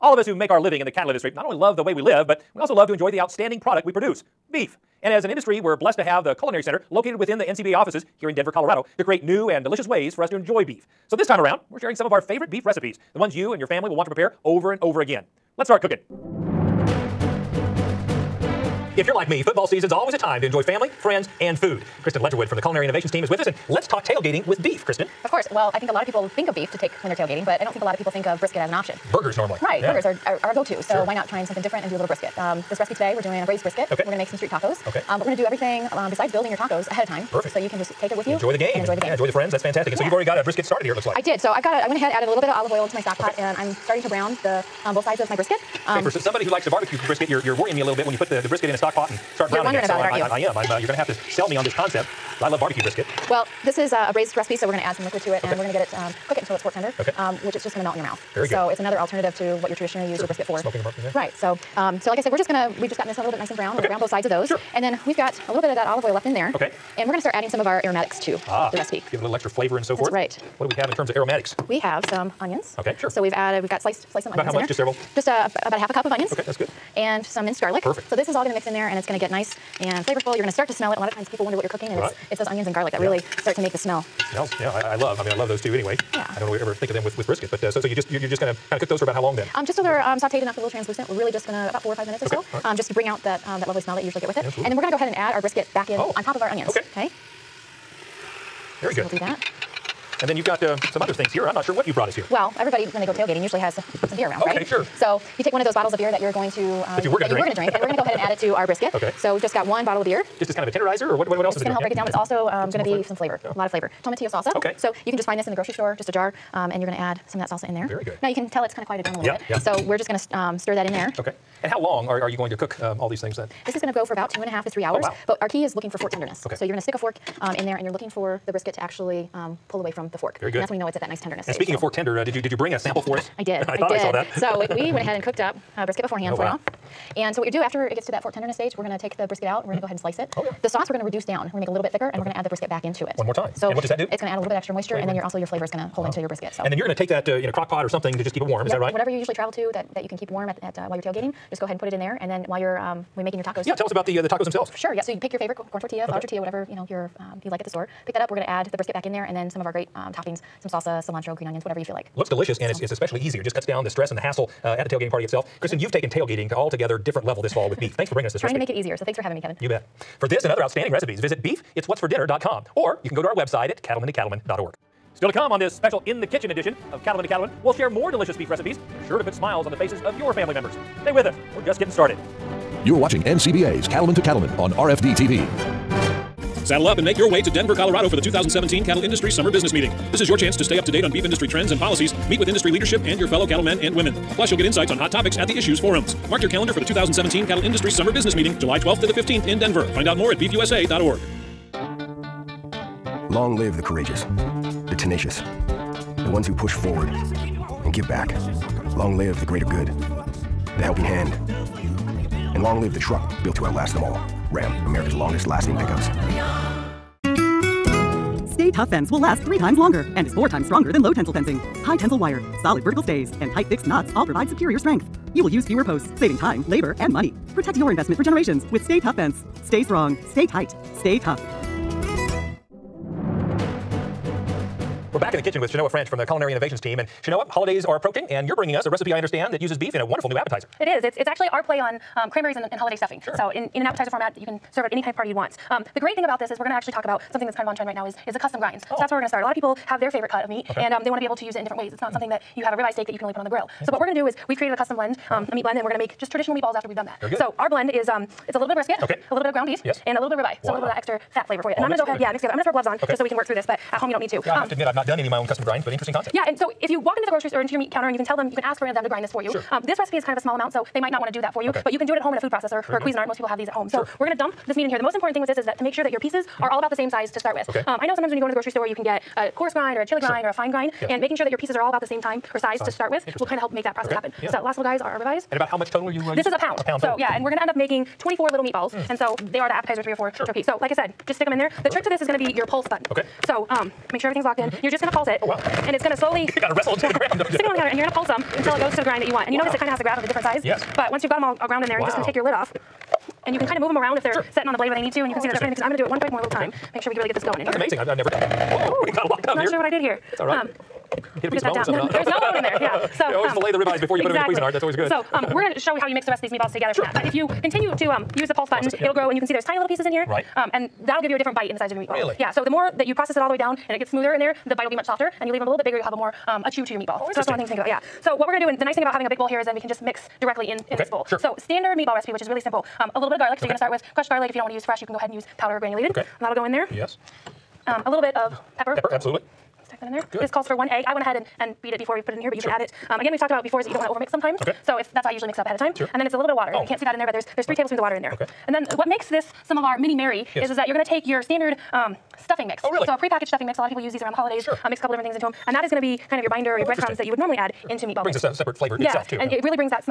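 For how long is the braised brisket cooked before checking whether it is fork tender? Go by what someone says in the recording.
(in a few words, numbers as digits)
2.5 to 3 hours.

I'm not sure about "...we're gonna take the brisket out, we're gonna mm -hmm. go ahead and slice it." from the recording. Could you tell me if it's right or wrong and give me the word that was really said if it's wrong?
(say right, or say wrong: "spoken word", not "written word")
right.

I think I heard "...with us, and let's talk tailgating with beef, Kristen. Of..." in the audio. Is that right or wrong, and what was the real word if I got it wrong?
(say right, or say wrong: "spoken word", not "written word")
right.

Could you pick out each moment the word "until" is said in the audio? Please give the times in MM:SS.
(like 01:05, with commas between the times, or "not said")
00:56, 04:58.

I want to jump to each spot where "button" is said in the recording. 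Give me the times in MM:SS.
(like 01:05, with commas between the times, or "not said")
04:52, 05:18.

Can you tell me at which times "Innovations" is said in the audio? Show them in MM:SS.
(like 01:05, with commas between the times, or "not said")
00:22, 03:56.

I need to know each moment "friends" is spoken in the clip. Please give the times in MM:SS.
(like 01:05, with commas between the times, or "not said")
00:20, 00:39.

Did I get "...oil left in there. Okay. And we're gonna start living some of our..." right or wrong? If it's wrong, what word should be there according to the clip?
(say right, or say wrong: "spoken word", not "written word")
wrong: "adding", not "living".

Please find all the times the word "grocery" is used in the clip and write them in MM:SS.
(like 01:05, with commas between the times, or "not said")
01:55, 04:27, 04:38.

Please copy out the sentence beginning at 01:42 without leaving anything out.
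Well, everybody, when they go tailgating, usually has some beer around, okay, right?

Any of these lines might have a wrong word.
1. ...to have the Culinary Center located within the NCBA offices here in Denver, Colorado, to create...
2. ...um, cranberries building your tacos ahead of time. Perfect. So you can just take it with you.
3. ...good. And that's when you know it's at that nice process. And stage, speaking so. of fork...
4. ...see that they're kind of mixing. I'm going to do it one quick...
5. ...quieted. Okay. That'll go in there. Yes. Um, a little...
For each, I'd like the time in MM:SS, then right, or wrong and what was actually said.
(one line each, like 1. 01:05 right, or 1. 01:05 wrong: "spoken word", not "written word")
1. 00:05 right
2. 00:35 wrong: "besides", not "cranberries"
3. 02:10 wrong: "tenderness", not "process"
4. 05:05 right
5. 05:35 wrong: "granulated", not "quieted".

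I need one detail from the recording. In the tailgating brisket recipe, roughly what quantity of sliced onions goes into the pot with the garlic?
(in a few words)
half a cup.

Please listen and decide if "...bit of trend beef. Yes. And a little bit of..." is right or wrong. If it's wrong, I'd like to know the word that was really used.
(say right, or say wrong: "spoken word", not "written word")
wrong: "ground", not "trend".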